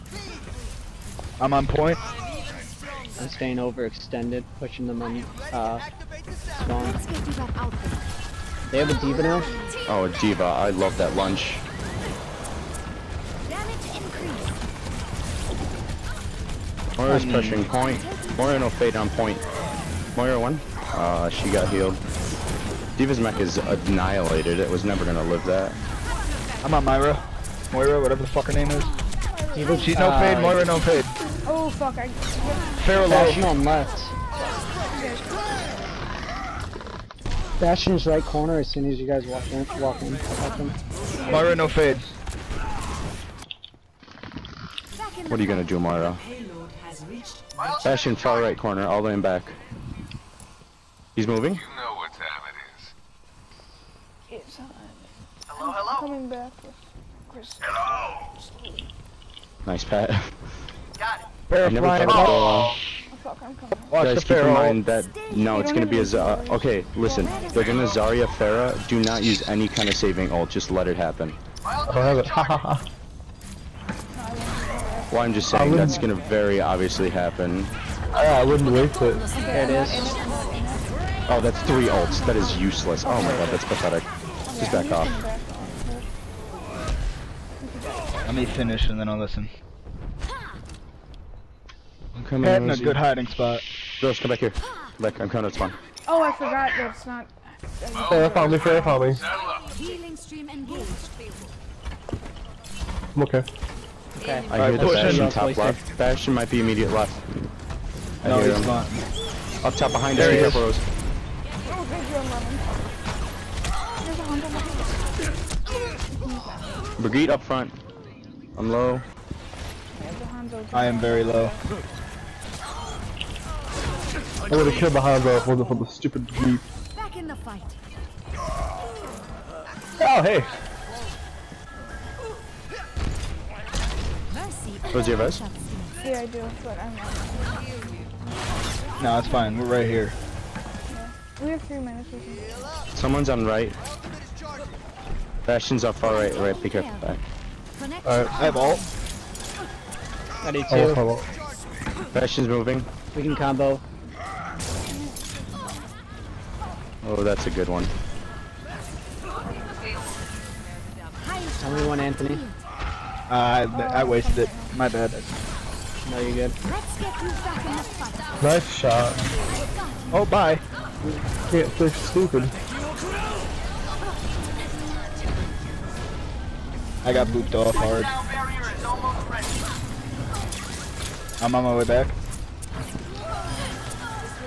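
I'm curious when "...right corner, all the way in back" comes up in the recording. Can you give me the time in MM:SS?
00:48.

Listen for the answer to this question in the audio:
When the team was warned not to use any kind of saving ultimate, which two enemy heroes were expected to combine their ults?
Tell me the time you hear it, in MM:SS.
01:07.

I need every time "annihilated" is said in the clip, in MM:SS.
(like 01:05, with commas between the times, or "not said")
00:23.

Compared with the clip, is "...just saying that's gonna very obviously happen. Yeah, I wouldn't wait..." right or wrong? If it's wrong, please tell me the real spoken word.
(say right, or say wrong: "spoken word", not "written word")
right.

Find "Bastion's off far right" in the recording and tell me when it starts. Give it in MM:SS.
02:25.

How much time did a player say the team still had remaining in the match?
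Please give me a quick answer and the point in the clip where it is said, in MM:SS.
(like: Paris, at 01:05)
3 minutes, at 02:21.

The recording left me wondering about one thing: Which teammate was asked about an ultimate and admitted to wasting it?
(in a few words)
Anthony.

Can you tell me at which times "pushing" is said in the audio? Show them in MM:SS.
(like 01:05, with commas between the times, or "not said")
00:04, 00:17.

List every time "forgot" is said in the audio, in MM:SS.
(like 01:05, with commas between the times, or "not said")
01:36.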